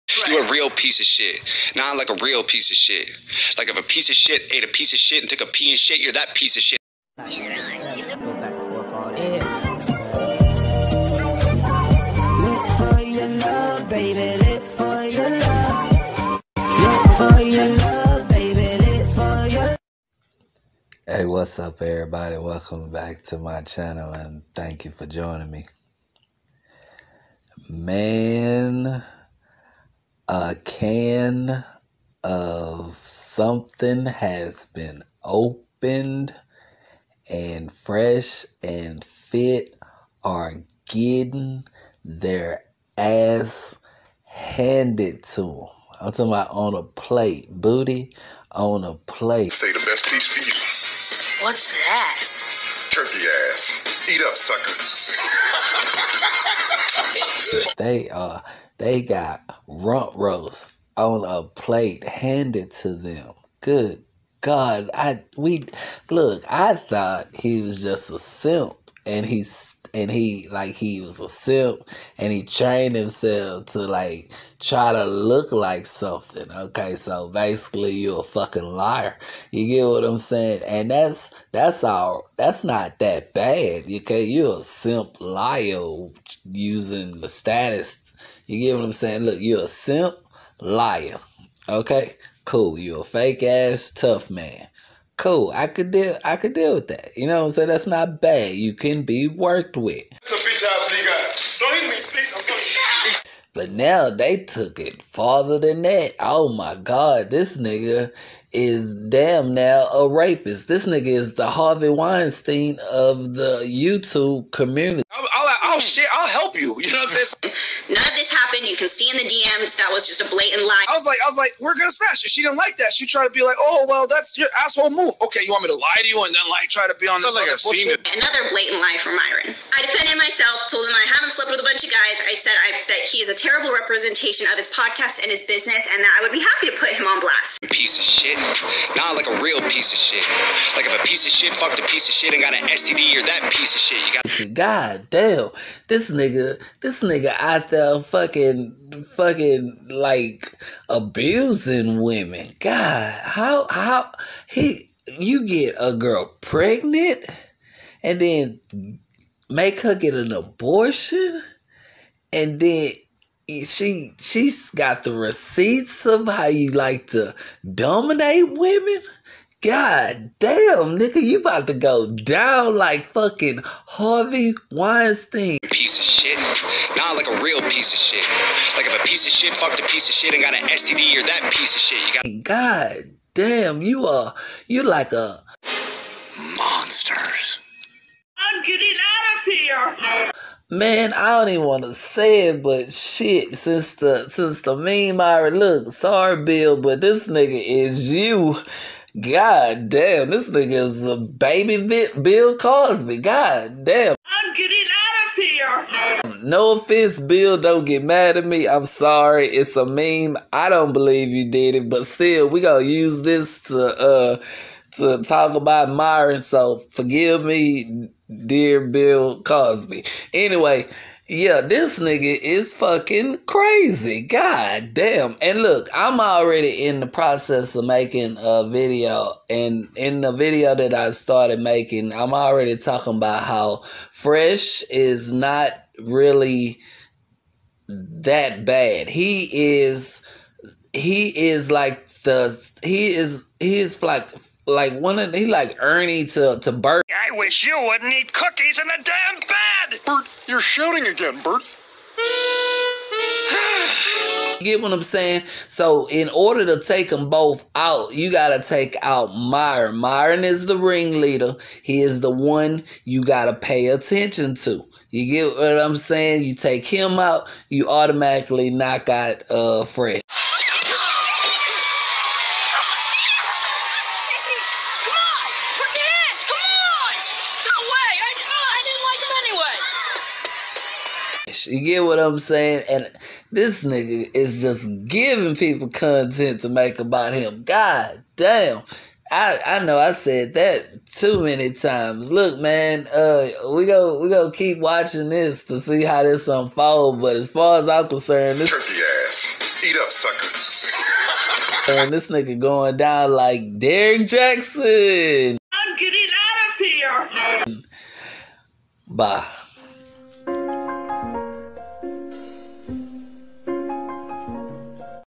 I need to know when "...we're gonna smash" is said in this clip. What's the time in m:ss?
2:01.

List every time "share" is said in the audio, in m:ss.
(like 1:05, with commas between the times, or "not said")
1:55.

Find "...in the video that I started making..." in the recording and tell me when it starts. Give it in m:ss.
3:49.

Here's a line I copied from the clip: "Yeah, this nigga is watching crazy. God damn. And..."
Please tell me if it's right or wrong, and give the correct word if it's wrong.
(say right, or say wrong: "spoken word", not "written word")
wrong: "fucking", not "watching".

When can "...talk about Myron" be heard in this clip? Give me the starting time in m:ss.
3:35.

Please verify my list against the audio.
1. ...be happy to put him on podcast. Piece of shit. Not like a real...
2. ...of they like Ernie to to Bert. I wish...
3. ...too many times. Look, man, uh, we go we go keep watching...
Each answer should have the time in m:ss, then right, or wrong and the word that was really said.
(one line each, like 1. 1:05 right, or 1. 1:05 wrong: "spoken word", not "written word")
1. 2:16 wrong: "blast", not "podcast"
2. 4:05 right
3. 4:51 right.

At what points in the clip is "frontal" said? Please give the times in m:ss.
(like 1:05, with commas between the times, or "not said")
not said.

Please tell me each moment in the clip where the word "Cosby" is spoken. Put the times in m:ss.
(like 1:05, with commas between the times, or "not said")
3:22, 3:39.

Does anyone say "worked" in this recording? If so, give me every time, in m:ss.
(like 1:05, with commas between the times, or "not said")
1:39.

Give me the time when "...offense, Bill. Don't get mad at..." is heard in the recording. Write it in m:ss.
3:26.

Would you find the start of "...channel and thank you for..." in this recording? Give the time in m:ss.
0:23.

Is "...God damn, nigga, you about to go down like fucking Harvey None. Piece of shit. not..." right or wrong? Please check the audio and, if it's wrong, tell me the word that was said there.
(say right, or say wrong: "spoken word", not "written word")
wrong: "Weinstein", not "None".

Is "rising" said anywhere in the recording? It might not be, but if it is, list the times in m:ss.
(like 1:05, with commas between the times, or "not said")
not said.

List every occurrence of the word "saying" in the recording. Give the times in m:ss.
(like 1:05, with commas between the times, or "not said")
1:20, 1:28, 1:37, 1:57, 4:15, 4:25, 4:42.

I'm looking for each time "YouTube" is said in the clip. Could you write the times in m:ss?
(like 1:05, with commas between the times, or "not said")
1:53.